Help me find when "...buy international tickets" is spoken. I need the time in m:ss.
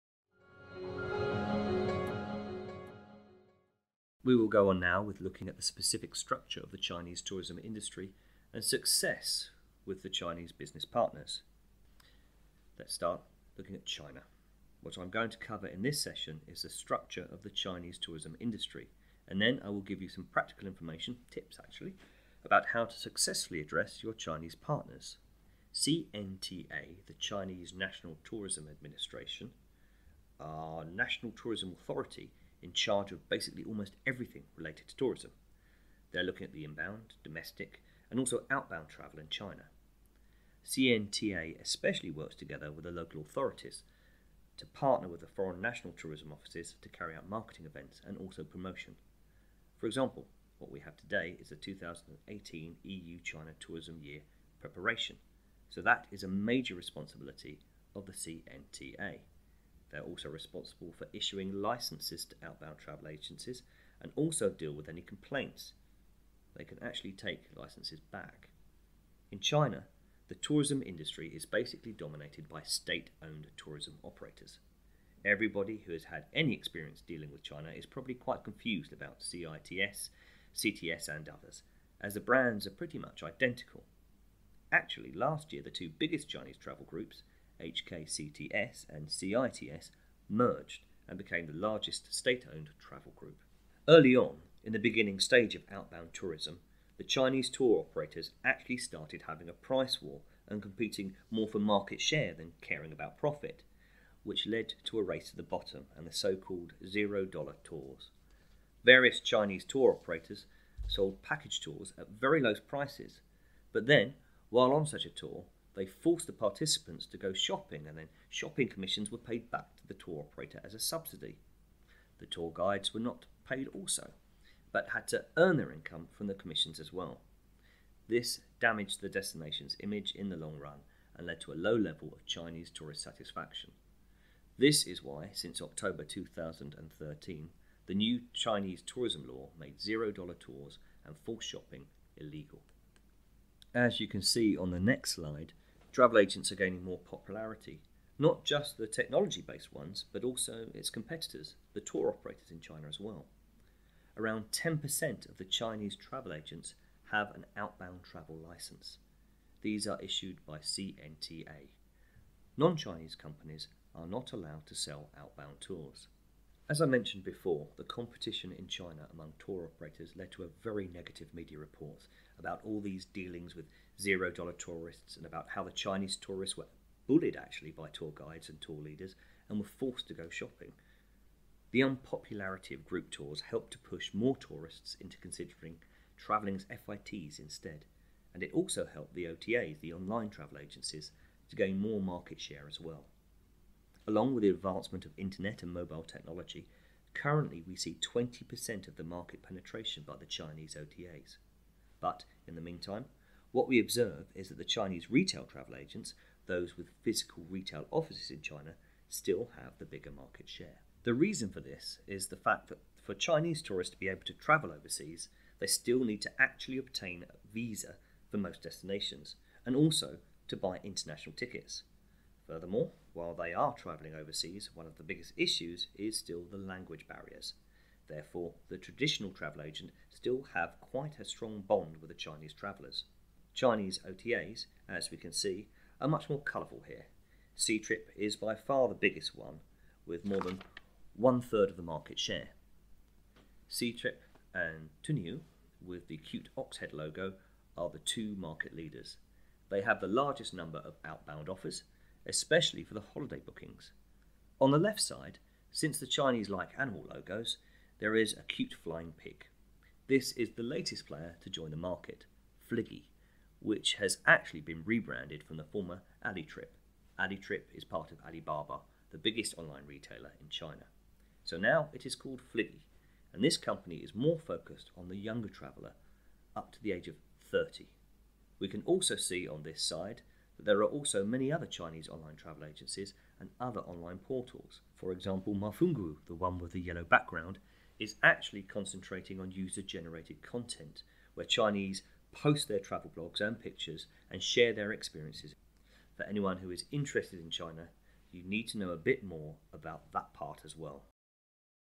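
3:40.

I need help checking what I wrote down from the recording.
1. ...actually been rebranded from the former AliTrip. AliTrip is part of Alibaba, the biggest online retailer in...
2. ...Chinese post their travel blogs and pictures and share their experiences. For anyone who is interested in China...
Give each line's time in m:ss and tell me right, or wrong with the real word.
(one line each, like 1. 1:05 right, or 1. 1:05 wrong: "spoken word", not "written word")
1. 4:24 right
2. 4:51 right.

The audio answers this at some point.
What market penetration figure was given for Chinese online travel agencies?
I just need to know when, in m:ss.
3:18.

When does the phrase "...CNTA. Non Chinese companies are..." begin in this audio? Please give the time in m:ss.
2:40.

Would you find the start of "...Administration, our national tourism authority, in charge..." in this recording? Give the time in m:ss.
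0:28.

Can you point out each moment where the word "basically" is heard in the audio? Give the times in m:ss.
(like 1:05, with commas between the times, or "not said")
0:33, 1:11.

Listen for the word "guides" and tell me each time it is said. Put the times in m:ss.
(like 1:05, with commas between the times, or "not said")
2:02, 2:58.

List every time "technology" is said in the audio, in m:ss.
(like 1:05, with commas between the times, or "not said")
2:28, 3:16.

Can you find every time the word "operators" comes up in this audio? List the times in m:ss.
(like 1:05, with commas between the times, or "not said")
1:14, 1:37, 1:49, 2:00, 2:32, 2:49.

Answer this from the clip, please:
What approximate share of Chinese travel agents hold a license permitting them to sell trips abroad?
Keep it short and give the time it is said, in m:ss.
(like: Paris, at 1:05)
10%, at 2:34.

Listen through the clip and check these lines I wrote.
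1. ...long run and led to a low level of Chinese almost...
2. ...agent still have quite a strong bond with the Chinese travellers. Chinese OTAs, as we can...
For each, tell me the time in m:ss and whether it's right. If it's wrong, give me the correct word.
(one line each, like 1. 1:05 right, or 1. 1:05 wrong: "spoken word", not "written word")
1. 2:10 wrong: "tourist", not "almost"
2. 3:49 right.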